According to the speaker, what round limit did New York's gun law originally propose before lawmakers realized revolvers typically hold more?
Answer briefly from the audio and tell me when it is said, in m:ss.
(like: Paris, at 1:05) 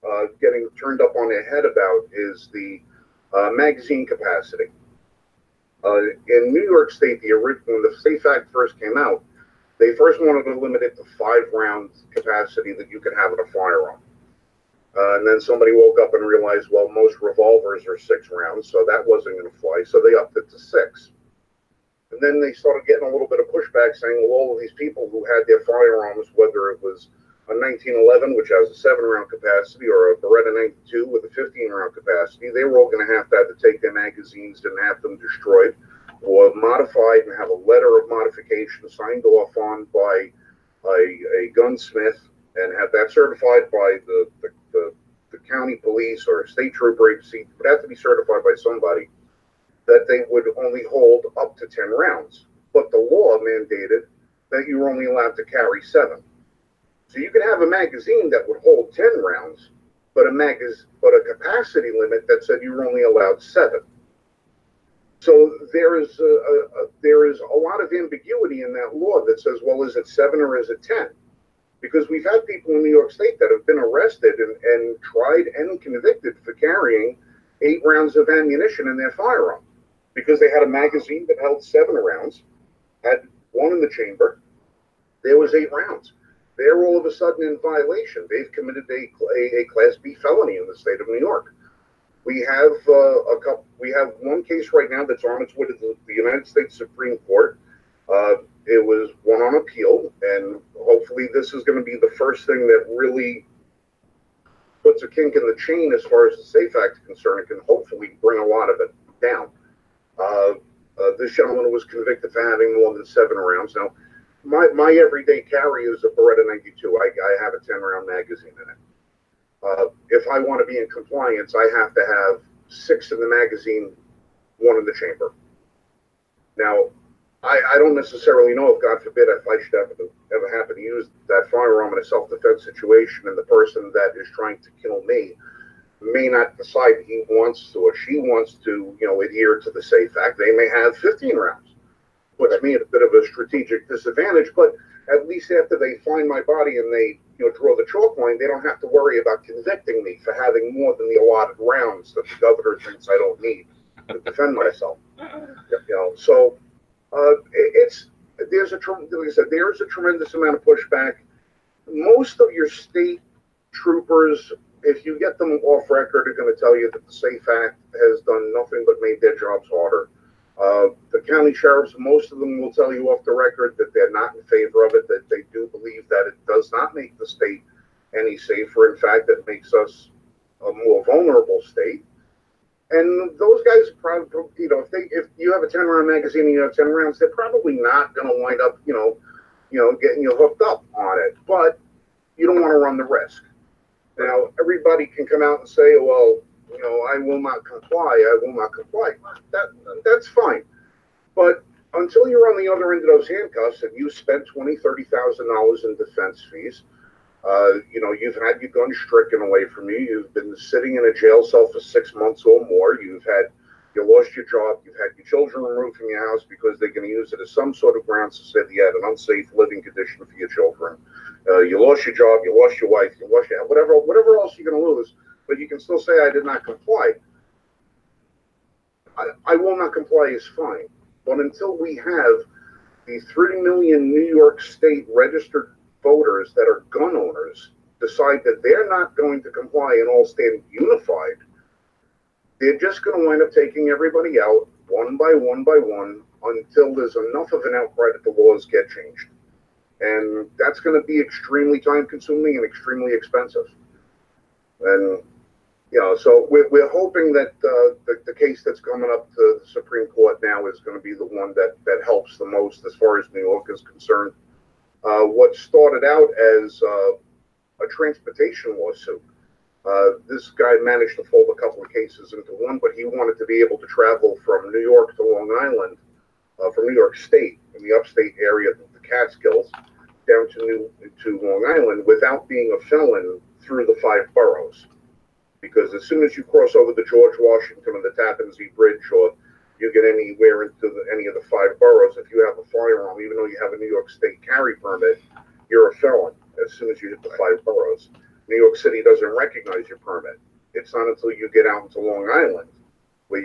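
5, at 0:11.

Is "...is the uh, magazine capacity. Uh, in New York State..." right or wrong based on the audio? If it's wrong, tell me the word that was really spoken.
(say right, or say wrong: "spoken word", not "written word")
right.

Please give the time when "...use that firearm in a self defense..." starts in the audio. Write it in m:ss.
2:10.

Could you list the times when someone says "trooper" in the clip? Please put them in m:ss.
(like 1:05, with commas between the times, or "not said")
0:46, 2:43.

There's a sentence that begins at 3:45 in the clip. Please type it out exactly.
But you can still say, I did not comply.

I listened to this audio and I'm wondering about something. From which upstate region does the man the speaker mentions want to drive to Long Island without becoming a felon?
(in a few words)
The Catskills.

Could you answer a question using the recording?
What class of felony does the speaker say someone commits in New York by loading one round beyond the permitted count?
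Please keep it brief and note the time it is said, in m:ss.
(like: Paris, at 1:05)
Class B, at 1:29.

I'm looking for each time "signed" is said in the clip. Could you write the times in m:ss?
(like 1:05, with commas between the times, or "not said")
0:38.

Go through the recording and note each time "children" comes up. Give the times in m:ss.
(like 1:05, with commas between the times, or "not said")
3:35, 3:40.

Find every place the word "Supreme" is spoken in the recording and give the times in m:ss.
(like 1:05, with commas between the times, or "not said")
1:36, 4:19.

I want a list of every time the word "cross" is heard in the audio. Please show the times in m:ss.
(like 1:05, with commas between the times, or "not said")
4:46.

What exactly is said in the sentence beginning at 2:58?
In fact, it makes us a more vulnerable state.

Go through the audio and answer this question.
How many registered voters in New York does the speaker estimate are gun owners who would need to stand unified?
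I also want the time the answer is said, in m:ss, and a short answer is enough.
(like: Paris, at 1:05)
3 million, at 3:53.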